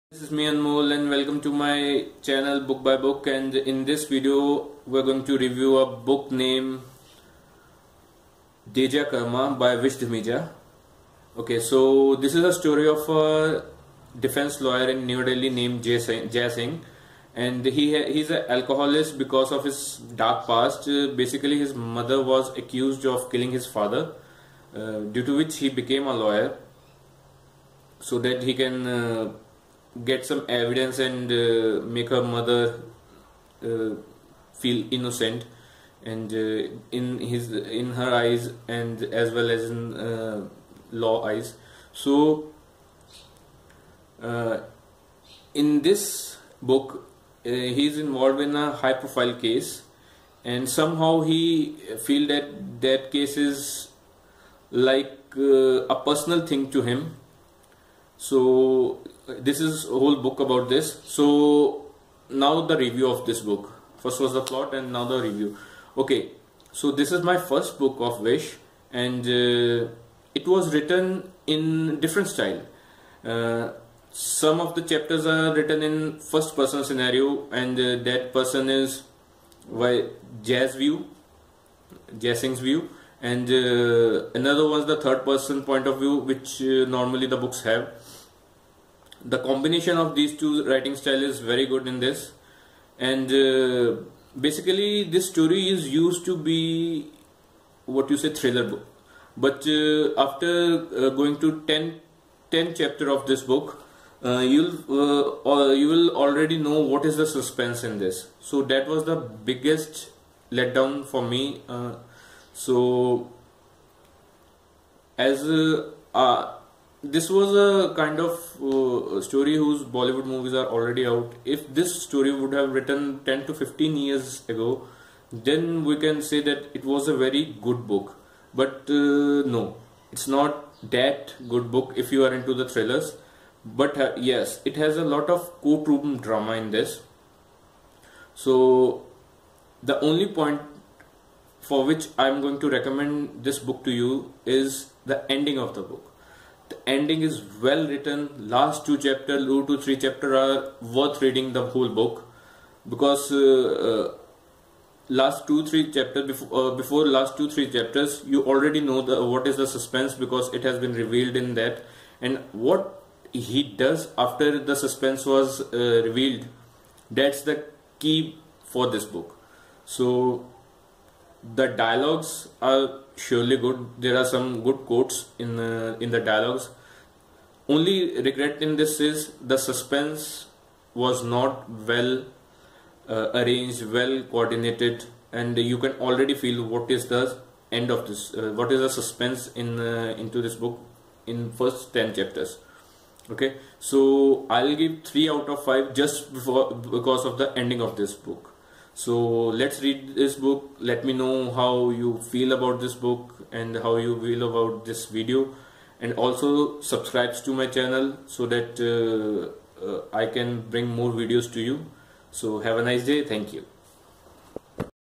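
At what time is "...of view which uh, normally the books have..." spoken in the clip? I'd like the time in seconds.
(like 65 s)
85 s.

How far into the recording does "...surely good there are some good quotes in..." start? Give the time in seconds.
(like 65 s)
173 s.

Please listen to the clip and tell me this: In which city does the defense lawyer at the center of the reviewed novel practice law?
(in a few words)
New Delhi.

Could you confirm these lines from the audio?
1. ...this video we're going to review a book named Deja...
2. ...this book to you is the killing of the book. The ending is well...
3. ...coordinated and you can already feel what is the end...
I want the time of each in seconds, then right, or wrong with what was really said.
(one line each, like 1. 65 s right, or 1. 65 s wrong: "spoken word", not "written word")
1. 3 s right
2. 143 s wrong: "ending", not "killing"
3. 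184 s right.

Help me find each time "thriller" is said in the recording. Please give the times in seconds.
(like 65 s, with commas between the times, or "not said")
98 s, 132 s.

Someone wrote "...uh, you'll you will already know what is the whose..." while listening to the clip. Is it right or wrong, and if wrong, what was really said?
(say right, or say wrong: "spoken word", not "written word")
wrong: "suspense", not "whose".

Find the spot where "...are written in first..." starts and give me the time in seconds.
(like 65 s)
75 s.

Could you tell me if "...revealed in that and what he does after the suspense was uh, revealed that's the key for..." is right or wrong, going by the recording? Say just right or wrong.
right.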